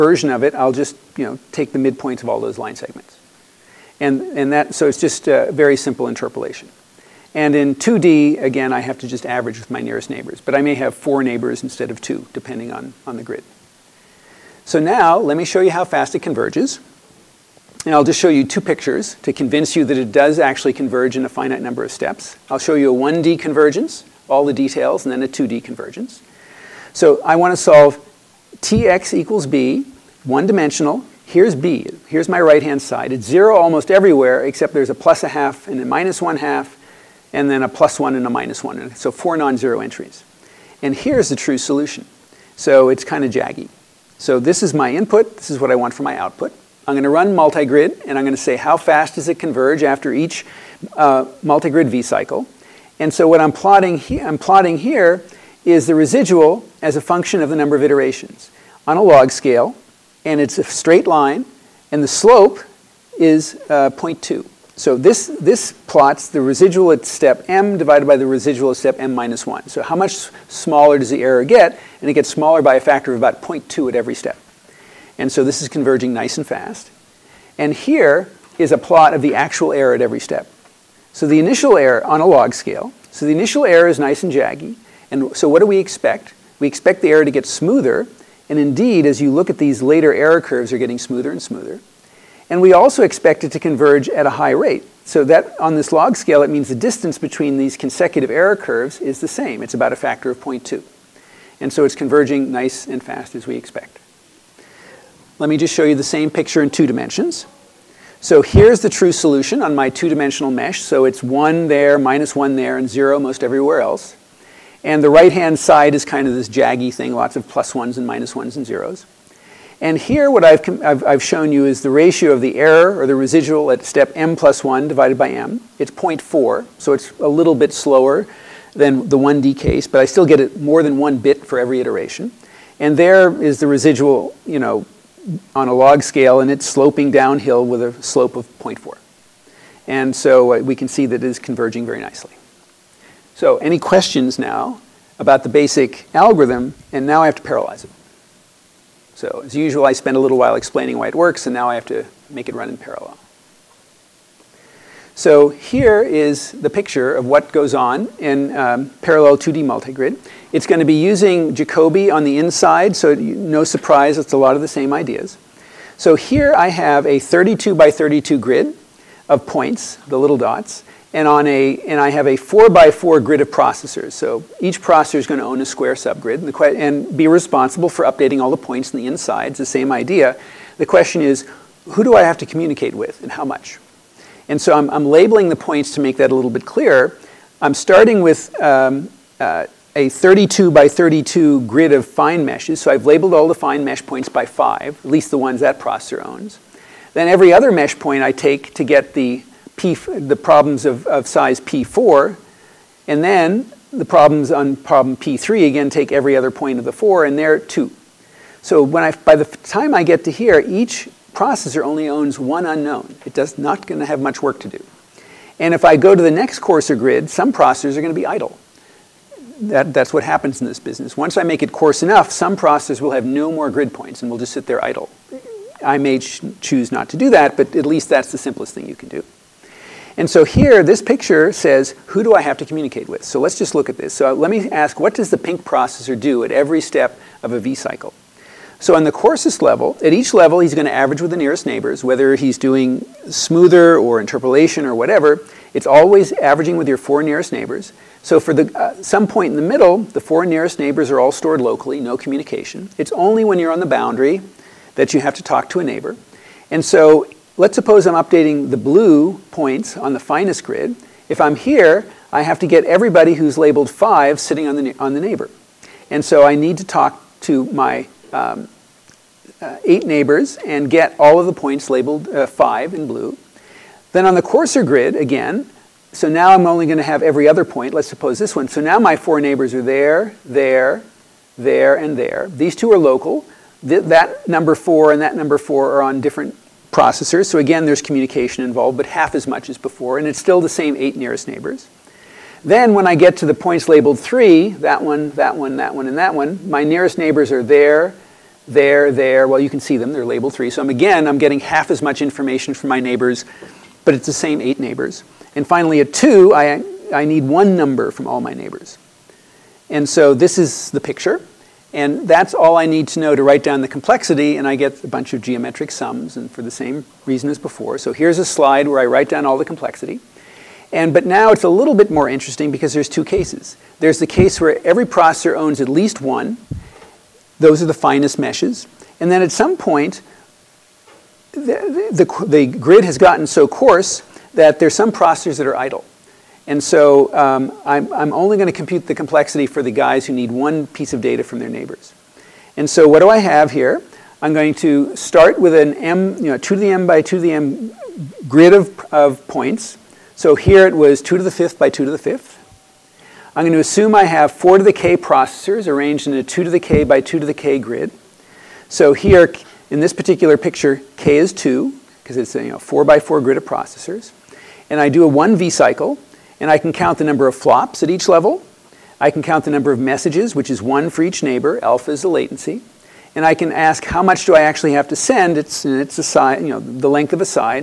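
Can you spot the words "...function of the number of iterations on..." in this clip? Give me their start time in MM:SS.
00:57.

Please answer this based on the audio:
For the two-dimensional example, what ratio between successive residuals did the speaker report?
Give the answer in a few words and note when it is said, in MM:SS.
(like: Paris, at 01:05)
0.4, at 02:05.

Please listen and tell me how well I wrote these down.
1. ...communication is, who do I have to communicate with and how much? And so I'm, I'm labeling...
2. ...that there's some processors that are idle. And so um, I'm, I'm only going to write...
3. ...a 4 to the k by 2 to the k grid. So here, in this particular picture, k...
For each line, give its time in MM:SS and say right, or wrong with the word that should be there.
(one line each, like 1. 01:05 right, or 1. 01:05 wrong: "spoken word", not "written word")
1. 03:00 wrong: "question", not "communication"
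2. 05:34 wrong: "compute", not "write"
3. 05:56 wrong: "2", not "4".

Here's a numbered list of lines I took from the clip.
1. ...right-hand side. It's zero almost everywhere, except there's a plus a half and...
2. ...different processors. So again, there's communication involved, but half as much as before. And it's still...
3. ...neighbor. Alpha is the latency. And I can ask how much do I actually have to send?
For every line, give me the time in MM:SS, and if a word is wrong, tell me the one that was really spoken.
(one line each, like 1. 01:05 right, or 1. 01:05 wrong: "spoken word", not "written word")
1. 00:32 right
2. 04:46 right
3. 06:11 right.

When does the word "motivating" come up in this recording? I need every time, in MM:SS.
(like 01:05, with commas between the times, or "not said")
not said.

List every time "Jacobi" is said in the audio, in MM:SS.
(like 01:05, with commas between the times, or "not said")
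02:41.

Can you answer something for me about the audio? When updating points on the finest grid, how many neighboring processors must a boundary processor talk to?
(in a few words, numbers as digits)
8.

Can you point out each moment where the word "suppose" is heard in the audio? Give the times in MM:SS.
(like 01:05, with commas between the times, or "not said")
04:17, 04:38.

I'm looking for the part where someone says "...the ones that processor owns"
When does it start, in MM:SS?
03:15.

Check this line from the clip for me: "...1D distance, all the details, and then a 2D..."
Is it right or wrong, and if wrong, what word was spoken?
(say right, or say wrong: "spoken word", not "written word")
wrong: "convergence", not "distance".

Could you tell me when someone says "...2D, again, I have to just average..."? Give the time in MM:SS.
00:07.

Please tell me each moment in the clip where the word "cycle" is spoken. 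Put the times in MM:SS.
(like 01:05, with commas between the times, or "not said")
00:52, 03:57, 06:05.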